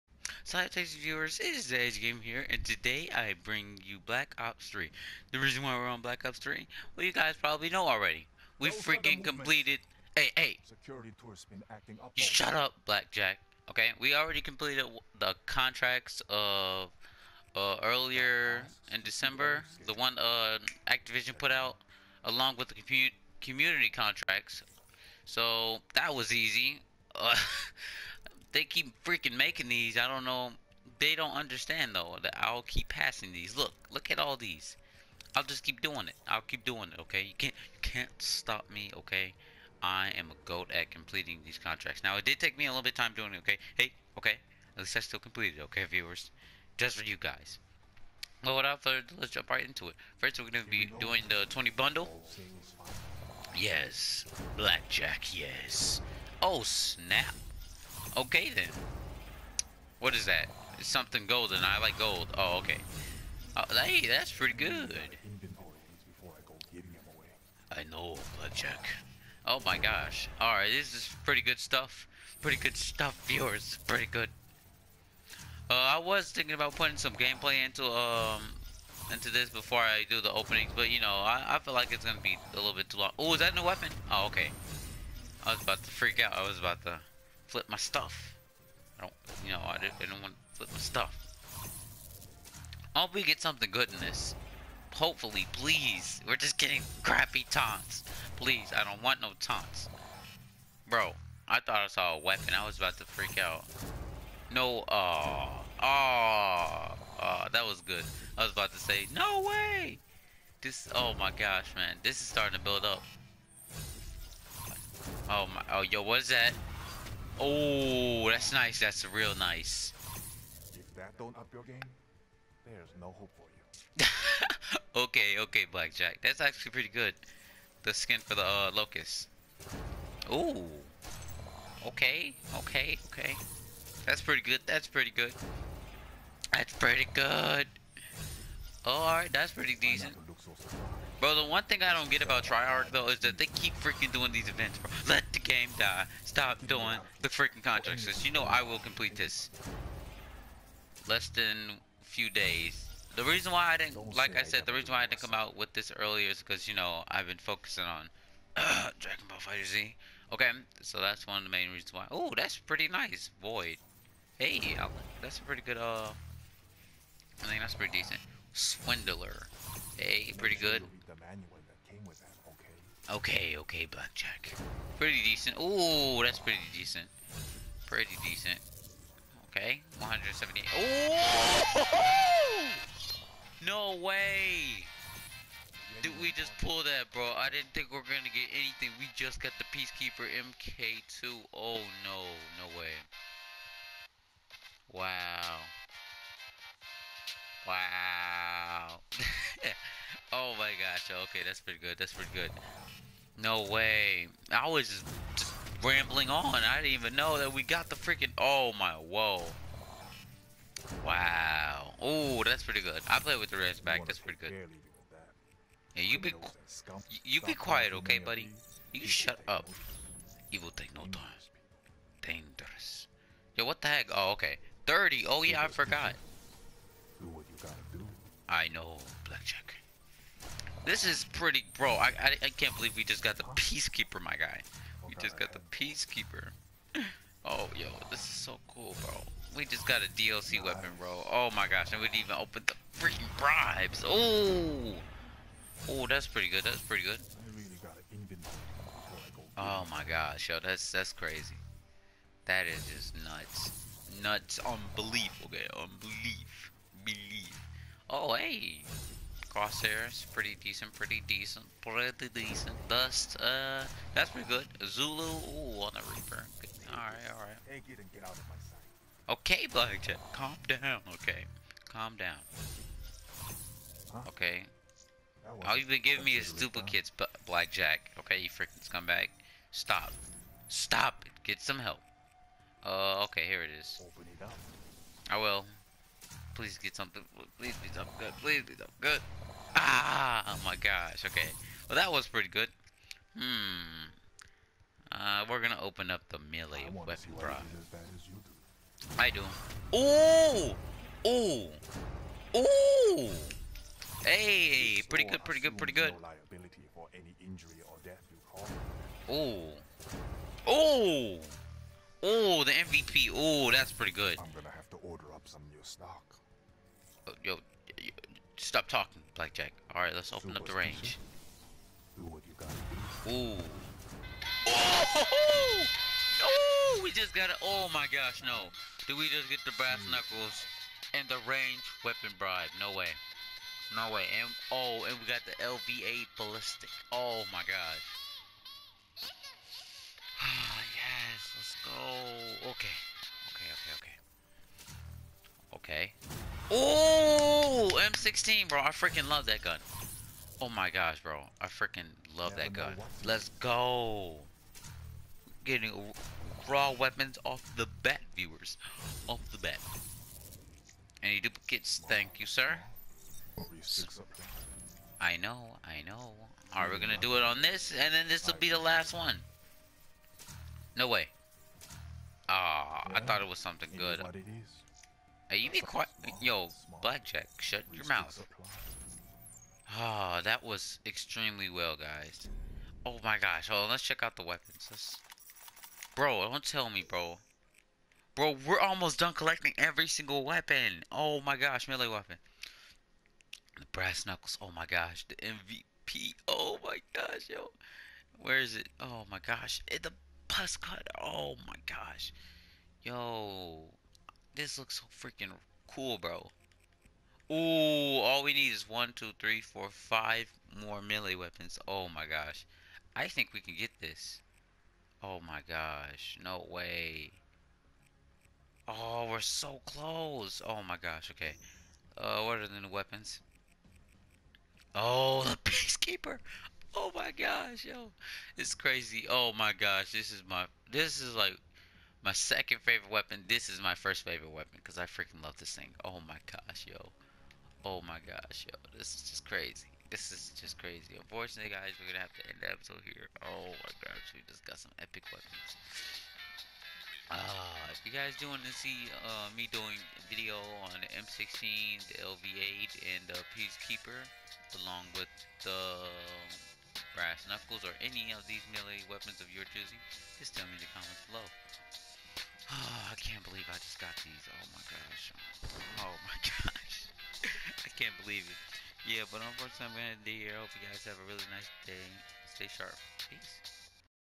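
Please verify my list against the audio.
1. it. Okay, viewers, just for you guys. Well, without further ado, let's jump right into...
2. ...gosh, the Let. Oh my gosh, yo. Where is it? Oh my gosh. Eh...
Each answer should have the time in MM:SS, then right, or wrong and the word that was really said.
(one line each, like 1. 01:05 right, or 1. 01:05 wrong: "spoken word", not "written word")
1. 00:45 right
2. 06:34 wrong: "MVP", not "Let".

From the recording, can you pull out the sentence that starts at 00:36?
Okay, you can't you can't stop me.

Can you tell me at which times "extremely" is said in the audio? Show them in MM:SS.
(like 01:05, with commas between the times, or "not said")
06:21.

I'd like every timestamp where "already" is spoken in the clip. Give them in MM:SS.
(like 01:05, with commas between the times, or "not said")
00:07, 00:14.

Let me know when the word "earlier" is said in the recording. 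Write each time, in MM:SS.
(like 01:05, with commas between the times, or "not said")
00:17, 02:35.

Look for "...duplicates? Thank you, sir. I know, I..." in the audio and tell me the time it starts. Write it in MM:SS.
06:01.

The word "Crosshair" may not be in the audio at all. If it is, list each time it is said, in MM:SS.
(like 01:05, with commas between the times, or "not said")
04:19.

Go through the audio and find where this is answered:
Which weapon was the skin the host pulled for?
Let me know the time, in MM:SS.
02:08.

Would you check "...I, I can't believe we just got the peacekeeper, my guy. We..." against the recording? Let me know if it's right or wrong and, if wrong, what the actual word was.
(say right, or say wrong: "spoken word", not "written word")
right.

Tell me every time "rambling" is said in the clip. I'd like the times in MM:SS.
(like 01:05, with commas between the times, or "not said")
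03:25.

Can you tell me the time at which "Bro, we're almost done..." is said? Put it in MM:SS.
06:28.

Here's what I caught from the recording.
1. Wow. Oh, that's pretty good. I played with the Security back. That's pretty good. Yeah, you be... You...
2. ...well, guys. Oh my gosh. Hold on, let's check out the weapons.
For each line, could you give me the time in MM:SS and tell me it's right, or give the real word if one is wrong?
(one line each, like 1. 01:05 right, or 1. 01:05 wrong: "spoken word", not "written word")
1. 03:31 wrong: "Reds", not "Security"
2. 06:21 right.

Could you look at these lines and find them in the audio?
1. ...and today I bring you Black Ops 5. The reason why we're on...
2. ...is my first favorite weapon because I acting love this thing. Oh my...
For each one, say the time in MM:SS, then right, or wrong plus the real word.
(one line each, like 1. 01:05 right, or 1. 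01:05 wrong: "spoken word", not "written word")
1. 00:02 wrong: "3", not "5"
2. 07:13 wrong: "freaking", not "acting".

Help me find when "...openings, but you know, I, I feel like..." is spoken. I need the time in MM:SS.
01:20.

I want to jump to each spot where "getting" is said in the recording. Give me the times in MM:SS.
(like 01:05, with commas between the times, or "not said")
01:36, 05:55.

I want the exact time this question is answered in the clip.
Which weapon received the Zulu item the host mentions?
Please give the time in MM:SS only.
04:26.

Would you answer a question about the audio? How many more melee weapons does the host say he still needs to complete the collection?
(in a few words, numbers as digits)
5.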